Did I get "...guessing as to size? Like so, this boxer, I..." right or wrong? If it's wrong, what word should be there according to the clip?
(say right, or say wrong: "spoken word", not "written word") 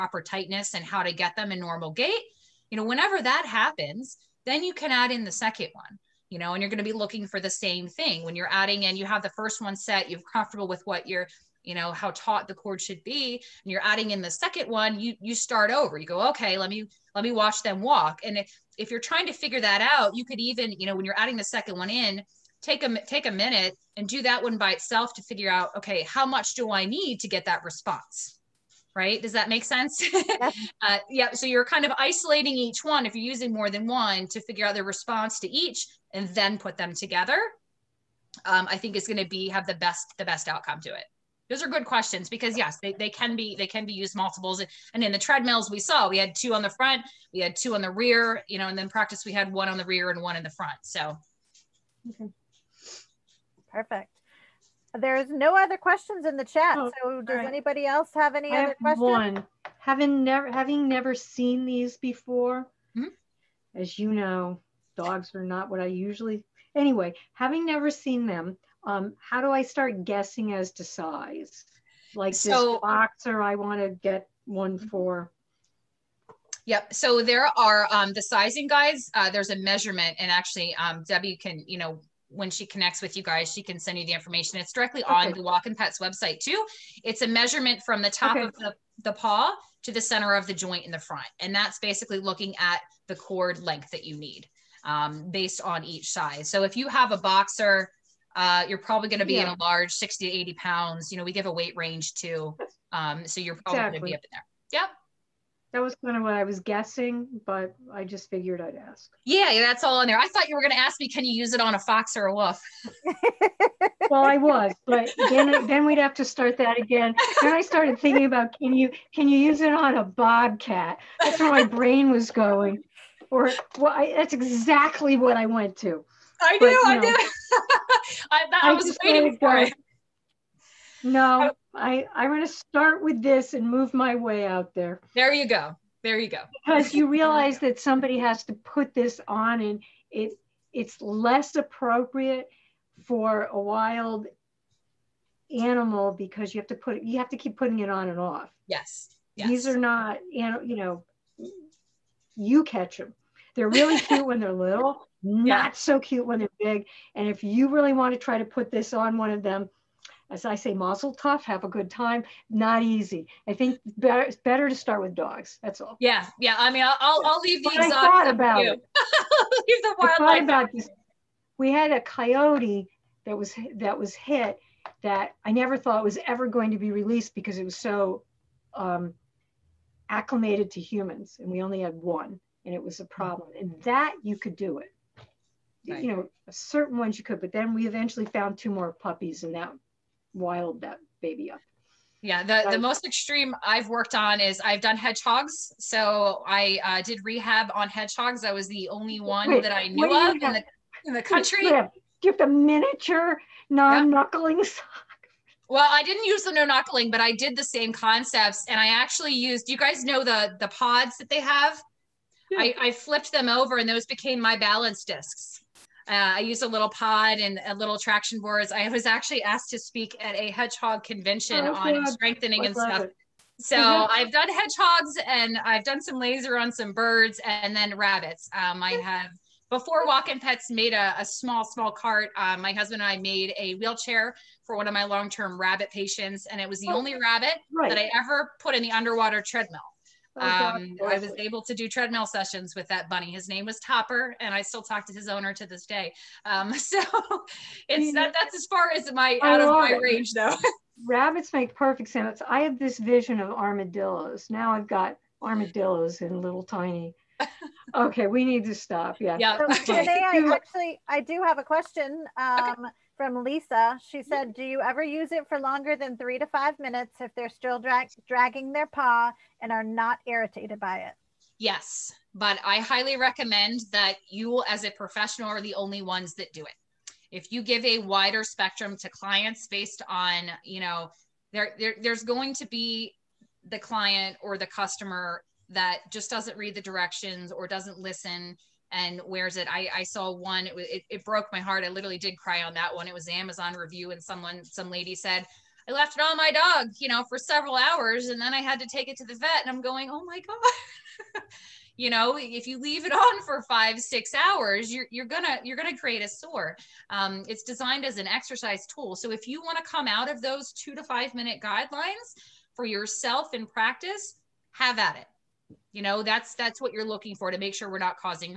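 right.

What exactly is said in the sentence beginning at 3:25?
Well, I didn't use the no knuckling, but I did the same concepts.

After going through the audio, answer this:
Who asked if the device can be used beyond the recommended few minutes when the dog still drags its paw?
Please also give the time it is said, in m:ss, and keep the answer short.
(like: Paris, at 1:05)
Lisa, at 4:23.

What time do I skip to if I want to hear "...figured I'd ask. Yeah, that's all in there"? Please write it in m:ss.
1:48.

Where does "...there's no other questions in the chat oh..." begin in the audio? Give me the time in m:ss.
0:54.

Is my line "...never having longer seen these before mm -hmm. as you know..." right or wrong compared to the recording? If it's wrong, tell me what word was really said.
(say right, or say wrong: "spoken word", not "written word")
wrong: "never", not "longer".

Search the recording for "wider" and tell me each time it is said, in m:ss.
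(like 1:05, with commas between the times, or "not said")
4:37.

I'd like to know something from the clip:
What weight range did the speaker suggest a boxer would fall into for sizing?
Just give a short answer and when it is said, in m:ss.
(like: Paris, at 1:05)
60 to 80 pounds, at 1:39.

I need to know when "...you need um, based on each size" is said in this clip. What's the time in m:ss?
1:34.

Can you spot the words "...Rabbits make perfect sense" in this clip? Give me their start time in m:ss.
4:11.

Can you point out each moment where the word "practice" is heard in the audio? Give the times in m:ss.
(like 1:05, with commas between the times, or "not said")
0:48, 5:13.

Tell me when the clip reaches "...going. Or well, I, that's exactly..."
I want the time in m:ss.
2:02.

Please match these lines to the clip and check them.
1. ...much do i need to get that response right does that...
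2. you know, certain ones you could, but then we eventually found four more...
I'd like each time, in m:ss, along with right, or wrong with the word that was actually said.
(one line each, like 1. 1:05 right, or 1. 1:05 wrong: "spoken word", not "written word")
1. 0:26 right
2. 3:06 wrong: "two", not "four".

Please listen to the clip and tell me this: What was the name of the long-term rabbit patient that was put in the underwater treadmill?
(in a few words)
Topper.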